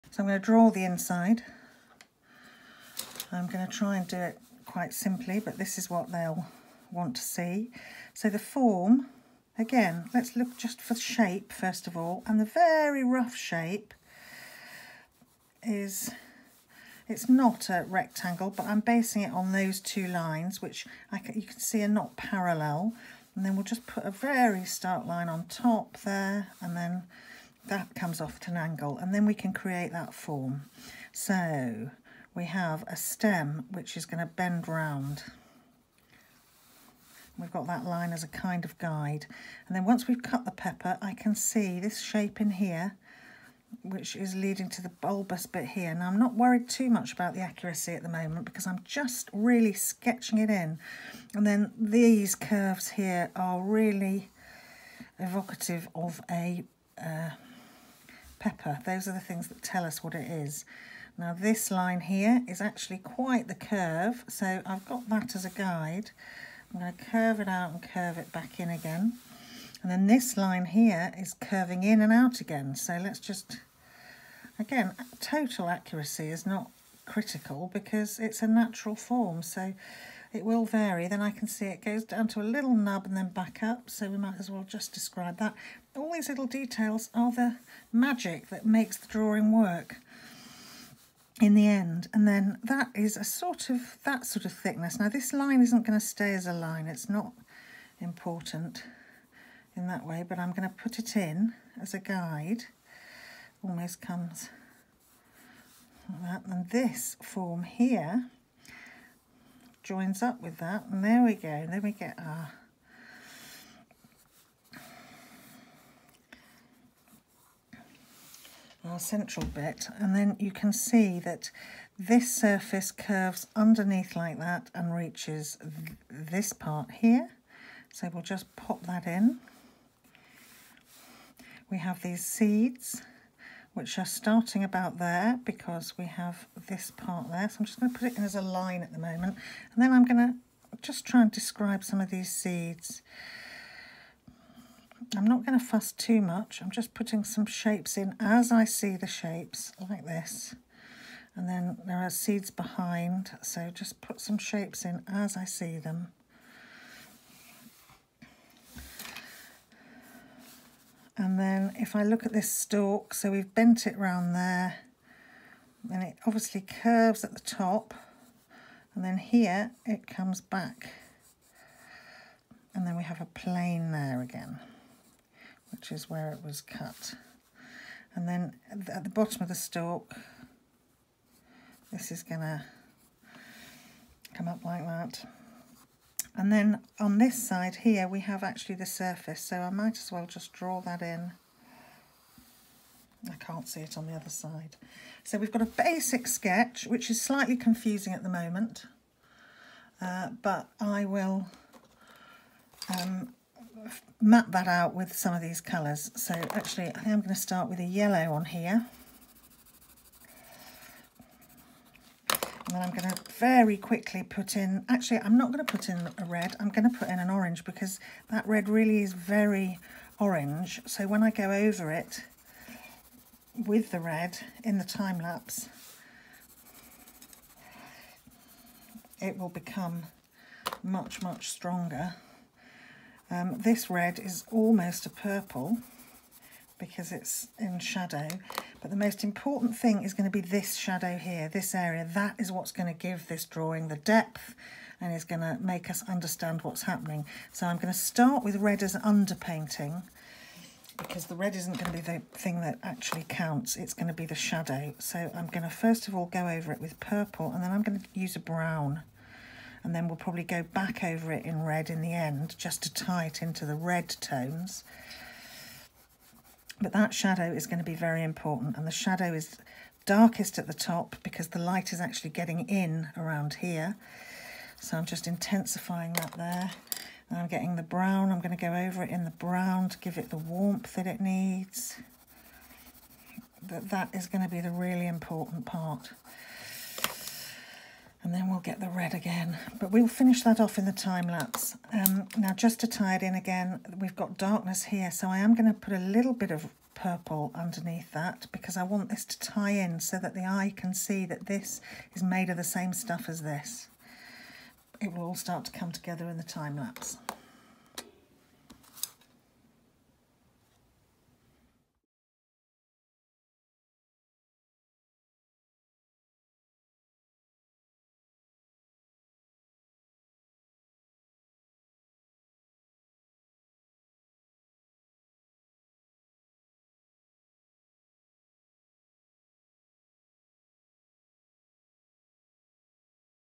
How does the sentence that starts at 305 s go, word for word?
It will all start to come together in the time lapse.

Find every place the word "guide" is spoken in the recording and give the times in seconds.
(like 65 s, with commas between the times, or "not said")
38 s, 65 s, 101 s.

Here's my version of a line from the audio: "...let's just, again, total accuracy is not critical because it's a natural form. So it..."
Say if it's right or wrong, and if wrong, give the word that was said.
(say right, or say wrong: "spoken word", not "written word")
right.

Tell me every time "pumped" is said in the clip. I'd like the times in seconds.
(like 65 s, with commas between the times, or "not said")
not said.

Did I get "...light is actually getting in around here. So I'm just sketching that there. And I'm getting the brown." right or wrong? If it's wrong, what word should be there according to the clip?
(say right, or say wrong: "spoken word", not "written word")
wrong: "intensifying", not "sketching".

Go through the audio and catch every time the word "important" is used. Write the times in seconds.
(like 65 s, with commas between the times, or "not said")
97 s, 239 s, 268 s, 285 s.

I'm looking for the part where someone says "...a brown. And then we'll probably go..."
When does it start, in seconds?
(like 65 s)
258 s.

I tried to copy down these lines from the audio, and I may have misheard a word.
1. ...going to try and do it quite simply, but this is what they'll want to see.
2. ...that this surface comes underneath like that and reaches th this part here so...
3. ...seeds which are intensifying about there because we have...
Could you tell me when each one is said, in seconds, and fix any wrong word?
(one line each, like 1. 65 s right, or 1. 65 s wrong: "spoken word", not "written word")
1. 3 s right
2. 121 s wrong: "curves", not "comes"
3. 132 s wrong: "starting", not "intensifying".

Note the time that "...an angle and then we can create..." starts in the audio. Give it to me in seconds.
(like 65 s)
28 s.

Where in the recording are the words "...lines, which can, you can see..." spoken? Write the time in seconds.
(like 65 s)
20 s.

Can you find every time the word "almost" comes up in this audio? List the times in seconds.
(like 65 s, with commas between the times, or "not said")
103 s, 234 s.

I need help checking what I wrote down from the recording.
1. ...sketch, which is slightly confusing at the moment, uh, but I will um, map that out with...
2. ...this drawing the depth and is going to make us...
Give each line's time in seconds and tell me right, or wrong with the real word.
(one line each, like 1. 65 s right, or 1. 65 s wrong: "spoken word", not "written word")
1. 196 s right
2. 243 s right.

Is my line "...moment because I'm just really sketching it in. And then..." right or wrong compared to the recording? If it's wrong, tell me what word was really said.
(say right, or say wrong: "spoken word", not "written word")
right.